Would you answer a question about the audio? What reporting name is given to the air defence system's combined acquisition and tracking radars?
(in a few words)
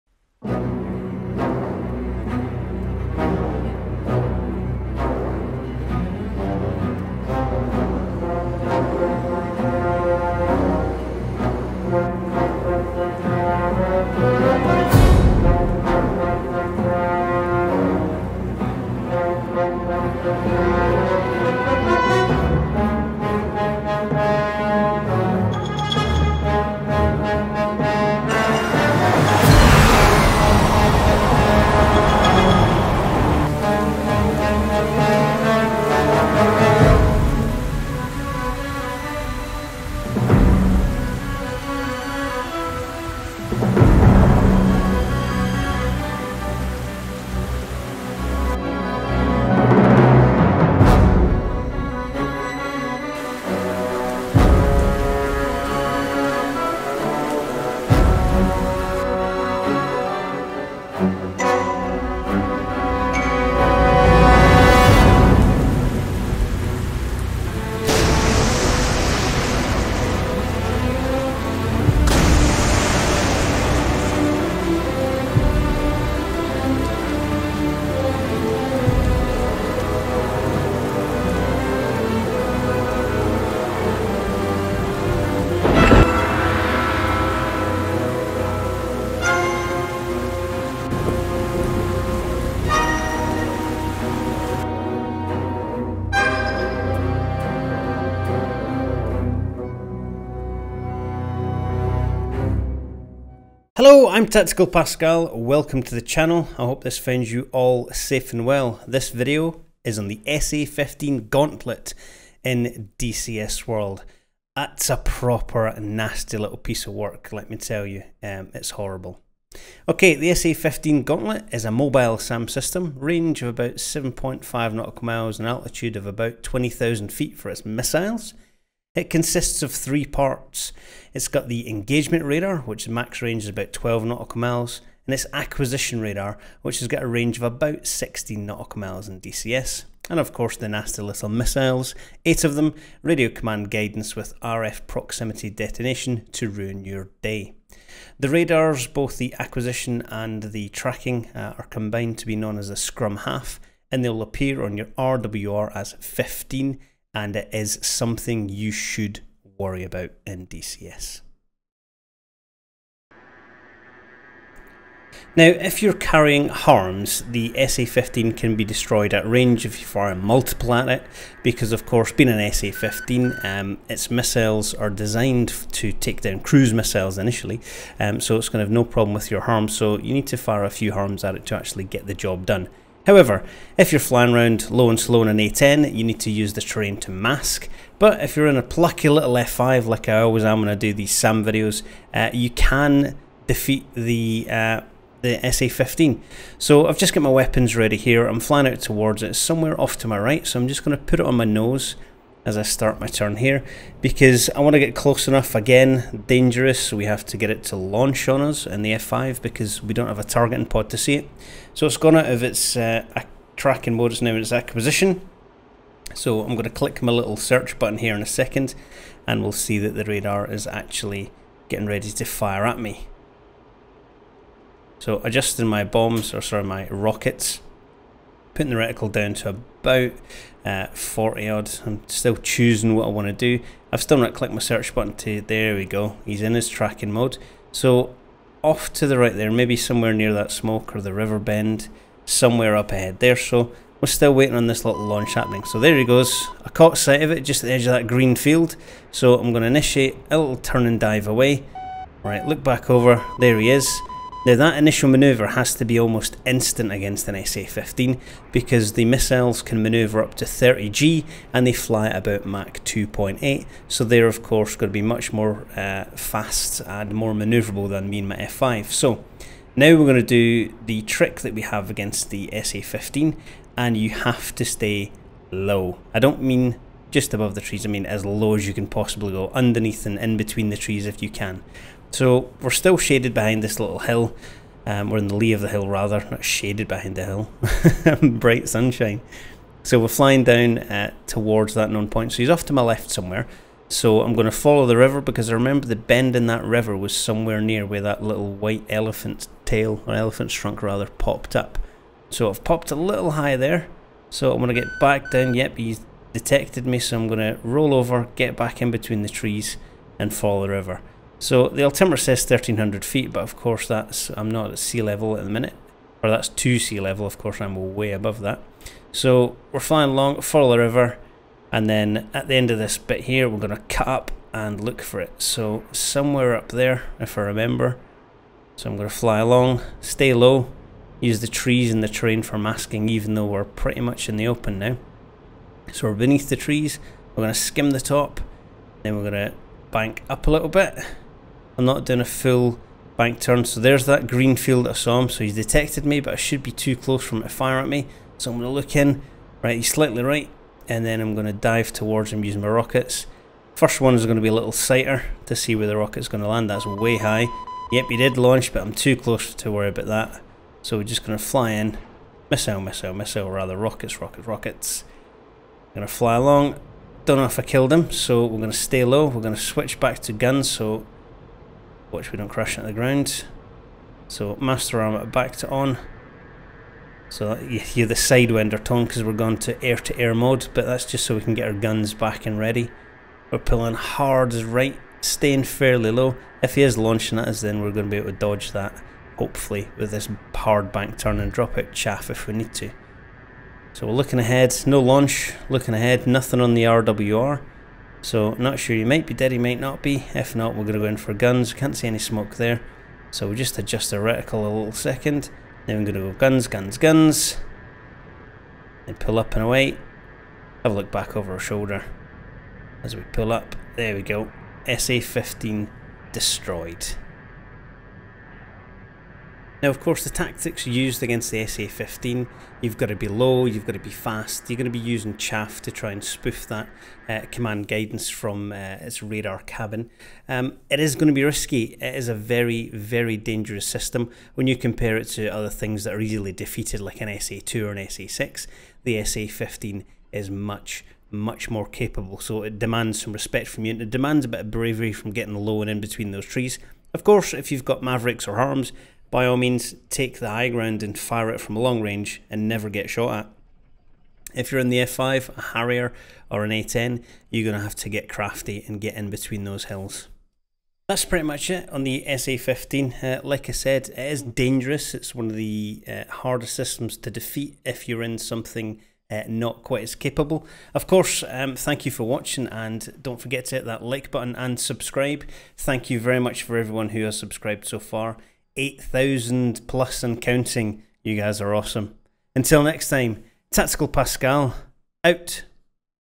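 scrum half.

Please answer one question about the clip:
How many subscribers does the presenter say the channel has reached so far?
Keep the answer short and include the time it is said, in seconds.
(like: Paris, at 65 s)
8,000 plus, at 478 s.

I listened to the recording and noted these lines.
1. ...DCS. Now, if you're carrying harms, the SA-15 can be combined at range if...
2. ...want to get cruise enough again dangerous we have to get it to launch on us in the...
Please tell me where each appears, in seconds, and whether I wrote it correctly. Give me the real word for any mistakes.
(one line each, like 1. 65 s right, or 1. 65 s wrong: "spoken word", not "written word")
1. 160 s wrong: "destroyed", not "combined"
2. 204 s wrong: "close", not "cruise".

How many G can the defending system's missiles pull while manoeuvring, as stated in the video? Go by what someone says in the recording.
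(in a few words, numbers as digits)
30G.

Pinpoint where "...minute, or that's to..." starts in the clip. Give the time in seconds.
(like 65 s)
315 s.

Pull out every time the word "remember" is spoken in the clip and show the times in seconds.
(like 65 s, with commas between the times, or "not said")
295 s, 327 s.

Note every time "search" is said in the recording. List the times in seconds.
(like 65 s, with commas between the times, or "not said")
217 s, 234 s.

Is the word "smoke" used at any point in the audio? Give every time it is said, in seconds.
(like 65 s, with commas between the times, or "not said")
240 s, 402 s.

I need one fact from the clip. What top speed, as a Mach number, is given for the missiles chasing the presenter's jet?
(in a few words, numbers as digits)
Mach 2.8.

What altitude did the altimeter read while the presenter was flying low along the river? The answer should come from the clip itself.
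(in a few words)
1300 feet.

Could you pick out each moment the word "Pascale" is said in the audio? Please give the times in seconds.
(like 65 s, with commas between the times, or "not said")
104 s, 484 s.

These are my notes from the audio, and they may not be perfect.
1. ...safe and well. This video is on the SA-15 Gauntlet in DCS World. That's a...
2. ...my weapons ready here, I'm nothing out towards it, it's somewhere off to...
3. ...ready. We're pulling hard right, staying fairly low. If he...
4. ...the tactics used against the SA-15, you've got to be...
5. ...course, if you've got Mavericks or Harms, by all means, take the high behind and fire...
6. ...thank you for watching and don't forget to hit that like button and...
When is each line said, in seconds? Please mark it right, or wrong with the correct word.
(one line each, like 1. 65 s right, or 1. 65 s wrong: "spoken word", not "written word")
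1. 107 s right
2. 197 s wrong: "flying", not "nothing"
3. 382 s right
4. 420 s right
5. 447 s wrong: "ground", not "behind"
6. 471 s right.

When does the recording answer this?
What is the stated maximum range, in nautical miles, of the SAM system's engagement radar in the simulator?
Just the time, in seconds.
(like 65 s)
133 s.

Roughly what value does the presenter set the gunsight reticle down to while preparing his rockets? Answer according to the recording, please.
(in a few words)
40.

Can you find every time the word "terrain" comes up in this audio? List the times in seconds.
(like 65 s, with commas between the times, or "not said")
186 s, 332 s.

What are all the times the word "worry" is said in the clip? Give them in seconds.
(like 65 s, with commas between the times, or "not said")
159 s, 359 s.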